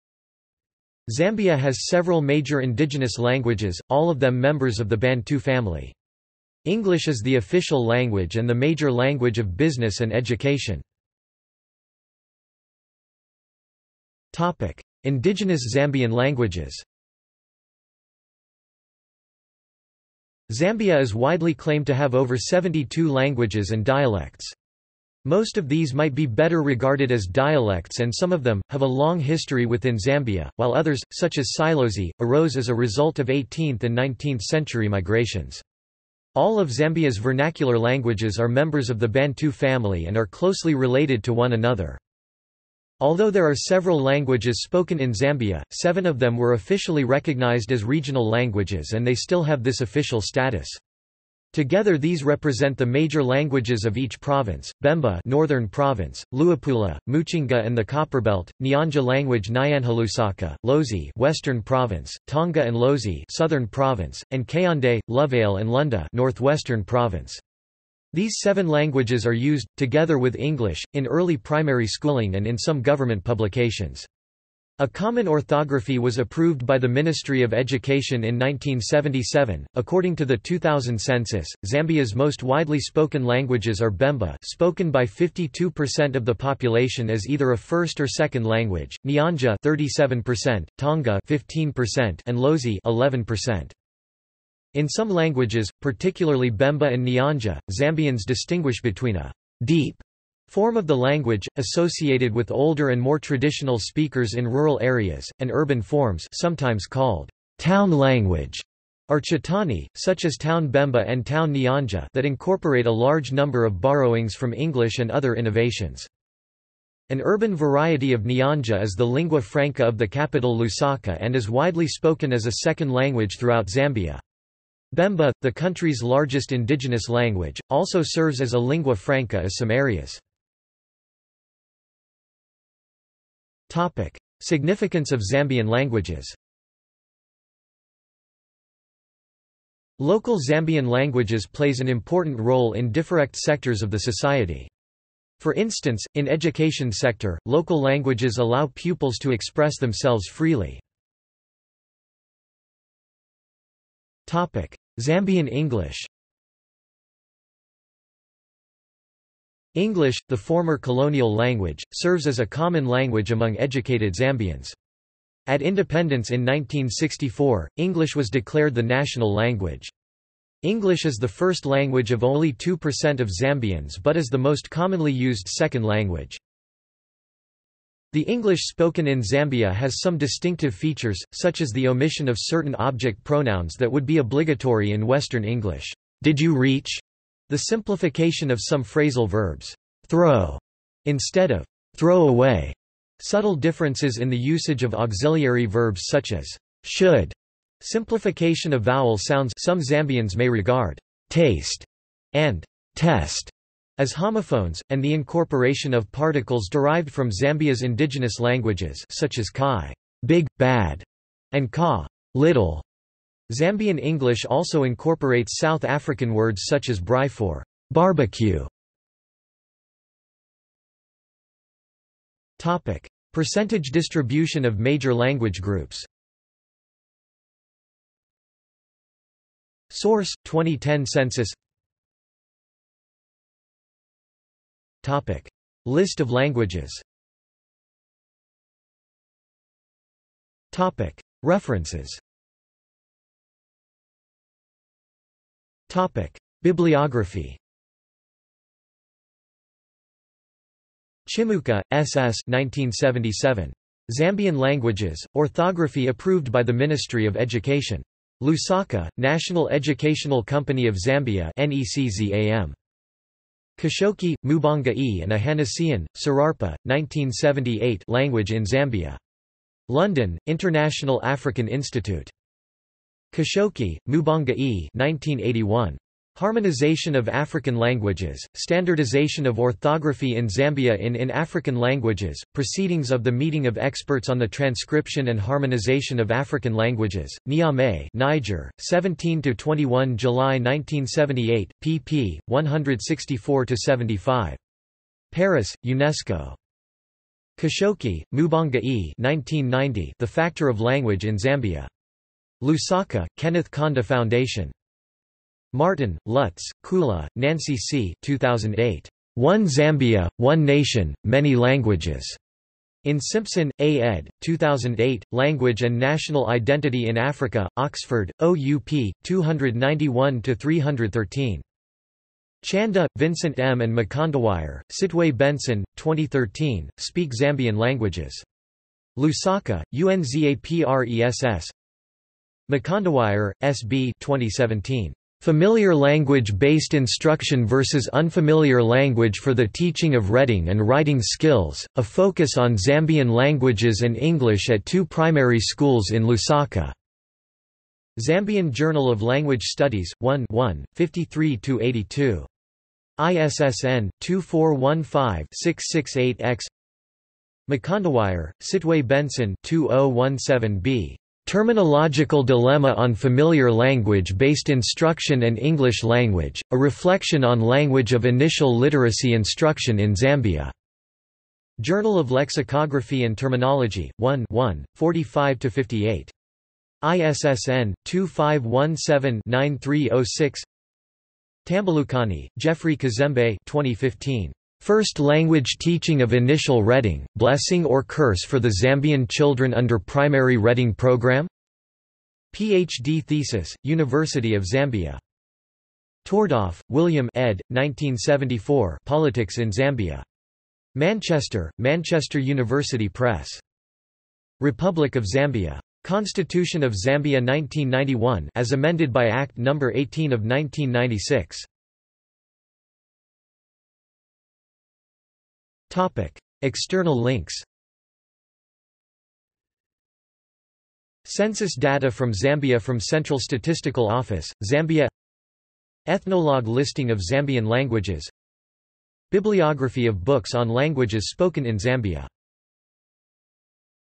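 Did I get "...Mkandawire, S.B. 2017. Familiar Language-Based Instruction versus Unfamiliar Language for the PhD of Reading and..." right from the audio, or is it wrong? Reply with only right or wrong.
wrong.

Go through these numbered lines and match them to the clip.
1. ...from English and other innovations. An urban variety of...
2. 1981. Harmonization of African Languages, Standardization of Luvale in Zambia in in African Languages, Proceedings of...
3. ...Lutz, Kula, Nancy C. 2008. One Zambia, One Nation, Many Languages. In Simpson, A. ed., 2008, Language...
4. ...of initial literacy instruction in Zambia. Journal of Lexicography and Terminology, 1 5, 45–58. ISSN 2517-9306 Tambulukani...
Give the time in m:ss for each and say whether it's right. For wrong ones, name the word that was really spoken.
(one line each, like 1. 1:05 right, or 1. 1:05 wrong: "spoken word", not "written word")
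1. 1:54 right
2. 4:34 wrong: "Orthography", not "Luvale"
3. 5:06 right
4. 6:08 wrong: "1", not "5".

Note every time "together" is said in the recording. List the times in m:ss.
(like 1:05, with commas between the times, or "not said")
0:51, 1:09.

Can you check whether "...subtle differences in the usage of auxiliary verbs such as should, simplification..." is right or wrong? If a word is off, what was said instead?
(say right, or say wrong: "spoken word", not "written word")
right.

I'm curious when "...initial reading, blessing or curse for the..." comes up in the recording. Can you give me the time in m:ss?
6:26.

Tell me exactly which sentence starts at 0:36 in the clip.
All of Zambia's vernacular languages are members of the Bantu family and are closely related to one another.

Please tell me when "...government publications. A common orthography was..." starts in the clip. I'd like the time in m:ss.
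1:12.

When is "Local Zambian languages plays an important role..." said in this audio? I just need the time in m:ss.
2:19.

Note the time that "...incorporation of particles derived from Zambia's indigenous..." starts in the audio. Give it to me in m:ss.
3:25.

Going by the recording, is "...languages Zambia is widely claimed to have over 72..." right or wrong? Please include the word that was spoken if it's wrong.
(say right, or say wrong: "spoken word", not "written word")
right.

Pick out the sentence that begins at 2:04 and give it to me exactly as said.
Bemba, the country's largest indigenous language, also serves as a lingua franca in some areas.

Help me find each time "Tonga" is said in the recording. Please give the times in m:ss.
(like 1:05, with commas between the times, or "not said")
1:02, 1:30.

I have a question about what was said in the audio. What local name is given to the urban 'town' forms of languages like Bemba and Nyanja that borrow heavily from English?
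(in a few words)
Chitauni.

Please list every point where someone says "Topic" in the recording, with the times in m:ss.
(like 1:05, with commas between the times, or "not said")
2:13, 2:34, 3:42, 3:55, 4:00, 4:05, 6:55.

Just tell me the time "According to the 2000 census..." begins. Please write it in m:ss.
1:19.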